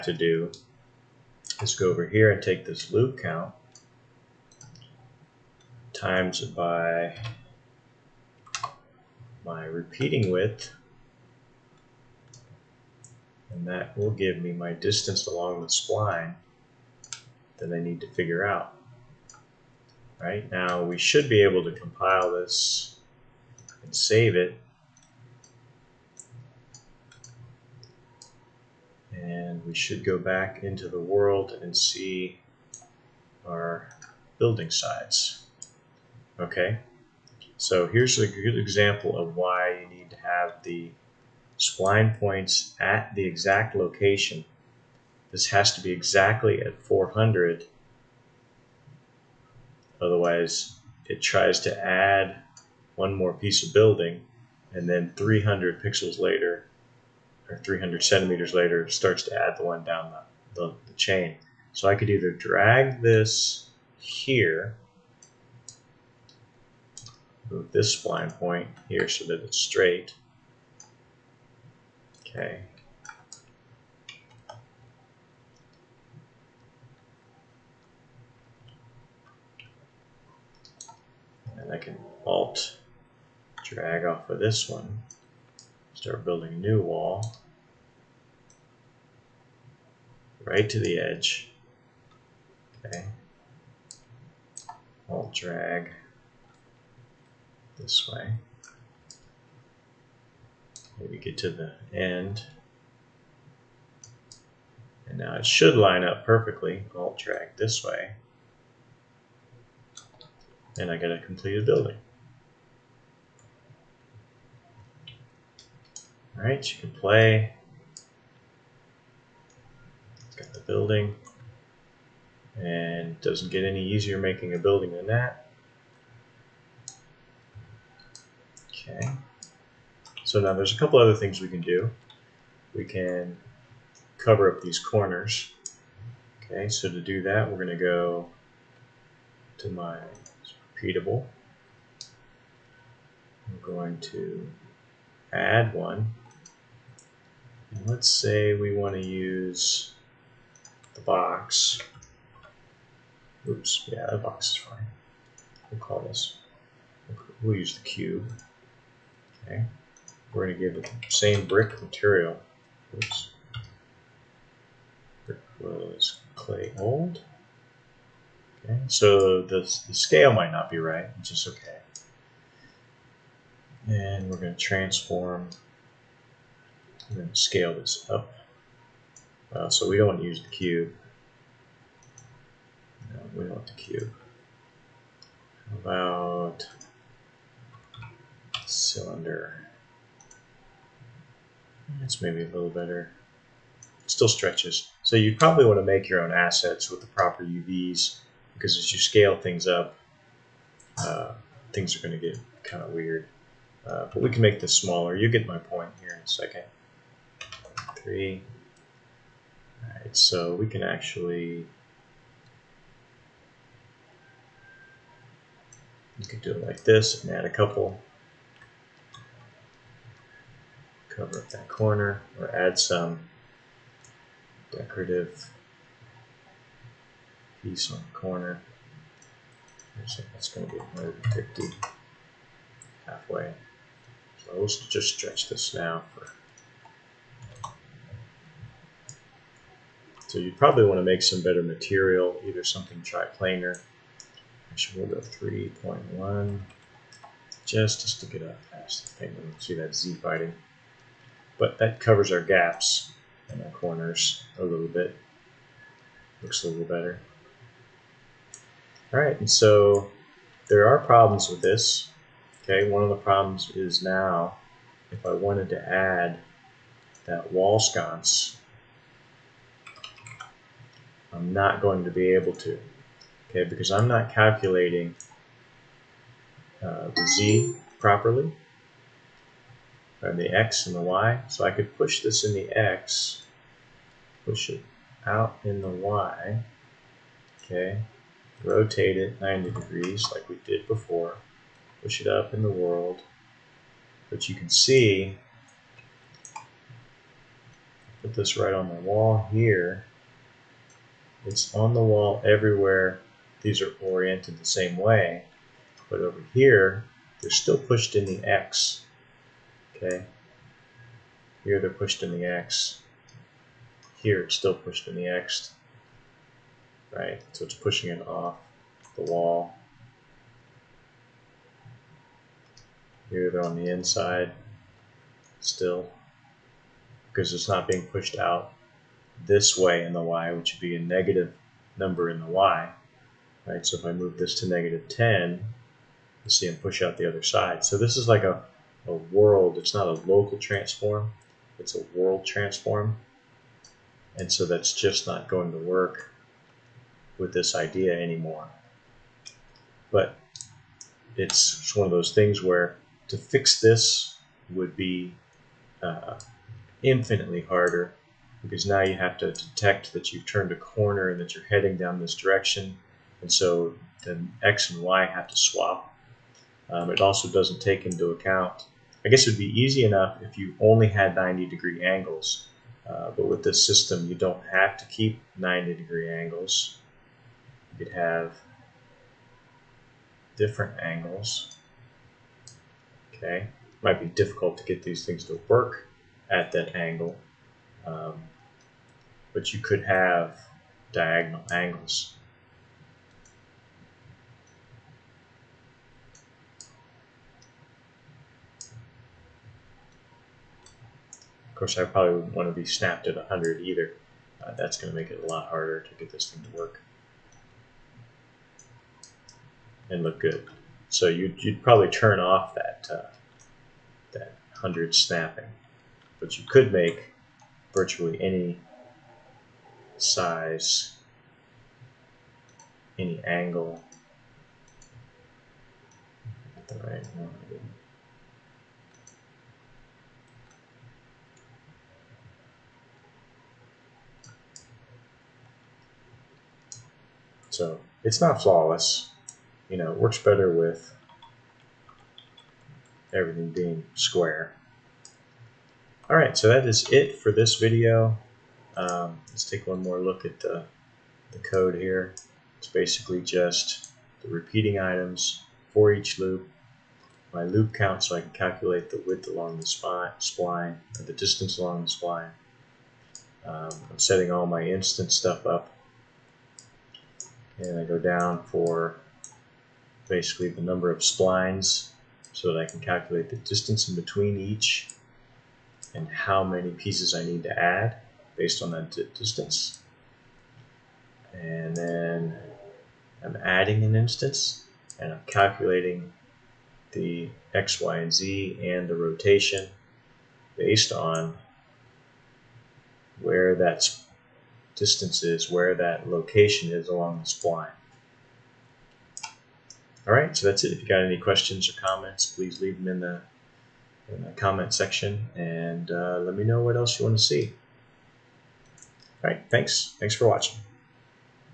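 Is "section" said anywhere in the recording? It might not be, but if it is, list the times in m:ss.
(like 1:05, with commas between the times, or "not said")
8:24.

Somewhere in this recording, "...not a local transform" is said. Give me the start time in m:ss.
5:39.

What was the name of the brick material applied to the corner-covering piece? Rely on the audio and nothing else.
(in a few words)
Clay old.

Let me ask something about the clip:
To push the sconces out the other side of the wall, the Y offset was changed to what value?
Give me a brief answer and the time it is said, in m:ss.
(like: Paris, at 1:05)
-10, at 5:34.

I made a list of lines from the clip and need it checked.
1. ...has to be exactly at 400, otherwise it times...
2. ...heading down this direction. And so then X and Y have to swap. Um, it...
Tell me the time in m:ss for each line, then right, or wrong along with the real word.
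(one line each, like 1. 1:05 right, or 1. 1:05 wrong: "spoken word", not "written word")
1. 0:45 wrong: "tries", not "times"
2. 6:01 right.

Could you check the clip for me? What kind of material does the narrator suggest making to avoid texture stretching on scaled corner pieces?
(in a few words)
Triplanar.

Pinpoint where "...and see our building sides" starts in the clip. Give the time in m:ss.
0:31.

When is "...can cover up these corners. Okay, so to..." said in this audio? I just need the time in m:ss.
2:12.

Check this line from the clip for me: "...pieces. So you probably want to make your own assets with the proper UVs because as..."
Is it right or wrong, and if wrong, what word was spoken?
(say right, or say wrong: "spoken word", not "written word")
wrong: "stretches", not "pieces".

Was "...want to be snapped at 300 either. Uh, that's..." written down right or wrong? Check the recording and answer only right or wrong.
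wrong.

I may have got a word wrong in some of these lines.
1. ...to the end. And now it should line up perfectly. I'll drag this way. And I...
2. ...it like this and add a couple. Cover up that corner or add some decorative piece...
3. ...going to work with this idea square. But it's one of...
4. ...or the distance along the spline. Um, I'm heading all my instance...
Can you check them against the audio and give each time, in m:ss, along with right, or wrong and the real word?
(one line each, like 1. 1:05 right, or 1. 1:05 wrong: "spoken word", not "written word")
1. 1:41 right
2. 3:36 right
3. 5:45 wrong: "anymore", not "square"
4. 7:41 wrong: "setting", not "heading".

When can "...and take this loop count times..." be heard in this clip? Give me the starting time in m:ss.
0:02.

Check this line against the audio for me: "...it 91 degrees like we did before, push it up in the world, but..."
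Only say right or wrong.
wrong.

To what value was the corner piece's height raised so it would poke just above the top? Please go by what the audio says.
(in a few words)
3.1.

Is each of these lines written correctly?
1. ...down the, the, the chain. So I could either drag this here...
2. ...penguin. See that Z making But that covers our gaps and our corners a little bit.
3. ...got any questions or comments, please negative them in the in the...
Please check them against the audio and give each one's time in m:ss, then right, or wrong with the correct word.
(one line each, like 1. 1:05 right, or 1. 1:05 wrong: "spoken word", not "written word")
1. 0:59 right
2. 4:09 wrong: "fighting", not "making"
3. 8:21 wrong: "leave", not "negative".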